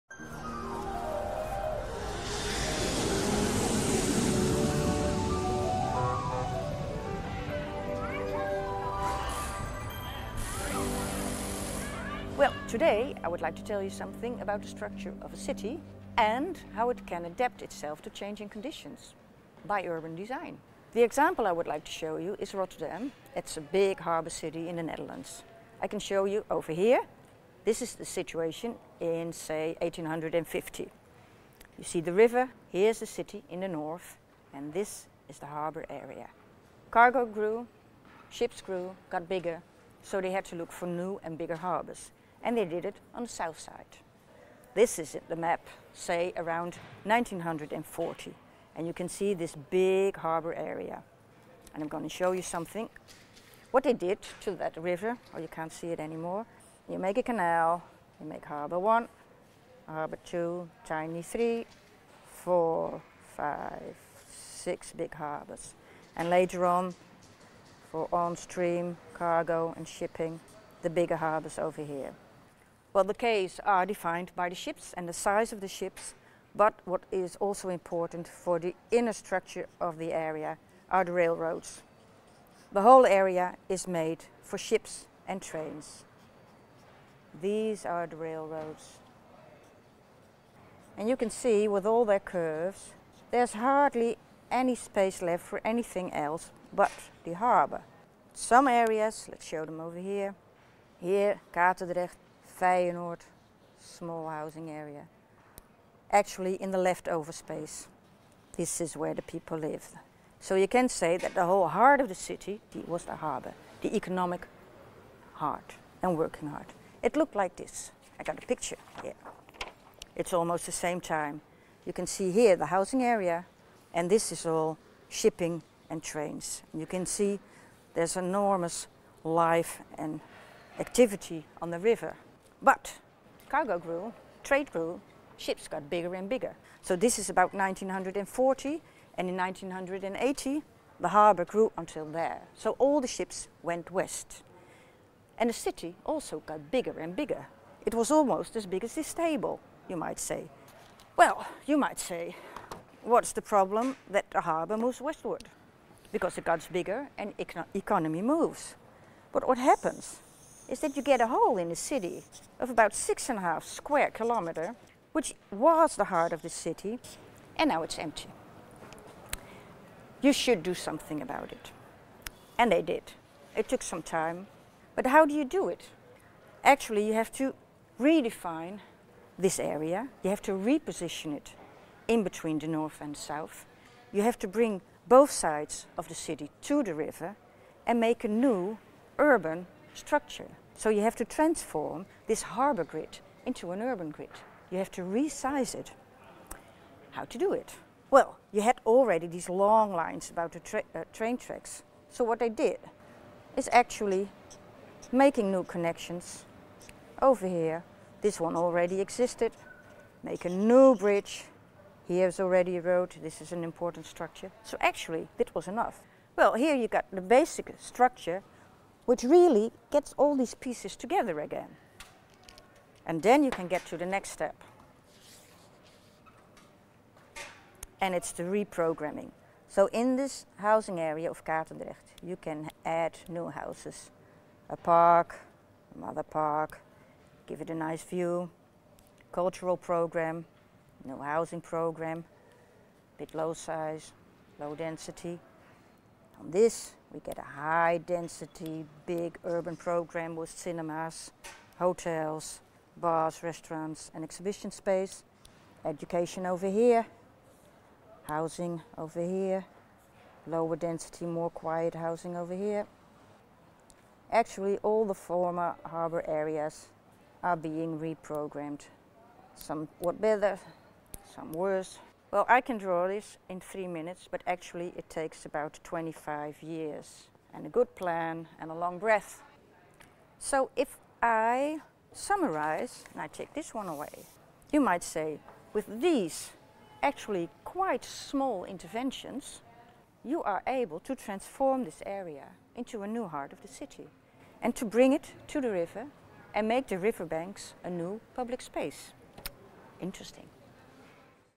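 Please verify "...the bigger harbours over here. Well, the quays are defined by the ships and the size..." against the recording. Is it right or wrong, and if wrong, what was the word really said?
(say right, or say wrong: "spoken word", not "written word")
right.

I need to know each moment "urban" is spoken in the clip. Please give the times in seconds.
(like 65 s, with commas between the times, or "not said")
19 s, 189 s, 193 s, 249 s.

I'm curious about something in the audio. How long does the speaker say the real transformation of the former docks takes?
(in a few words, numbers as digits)
25 years.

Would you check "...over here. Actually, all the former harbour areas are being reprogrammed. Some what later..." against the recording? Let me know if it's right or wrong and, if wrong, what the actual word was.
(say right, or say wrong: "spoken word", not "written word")
wrong: "better", not "later".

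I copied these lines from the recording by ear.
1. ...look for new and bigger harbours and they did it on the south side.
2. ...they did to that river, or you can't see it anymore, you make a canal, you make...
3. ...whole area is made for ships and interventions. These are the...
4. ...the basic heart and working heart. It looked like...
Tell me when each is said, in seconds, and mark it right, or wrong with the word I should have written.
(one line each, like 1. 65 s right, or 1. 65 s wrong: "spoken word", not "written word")
1. 40 s right
2. 53 s right
3. 82 s wrong: "trains", not "interventions"
4. 113 s wrong: "economic", not "basic".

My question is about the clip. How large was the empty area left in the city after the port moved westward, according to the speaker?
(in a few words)
6.5 square kilometers.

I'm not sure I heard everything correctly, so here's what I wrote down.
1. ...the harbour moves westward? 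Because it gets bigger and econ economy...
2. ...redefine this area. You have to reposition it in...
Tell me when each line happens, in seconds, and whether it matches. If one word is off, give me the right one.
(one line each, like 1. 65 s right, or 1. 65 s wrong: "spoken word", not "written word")
1. 154 s right
2. 177 s right.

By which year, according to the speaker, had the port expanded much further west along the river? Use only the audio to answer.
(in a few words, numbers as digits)
1980.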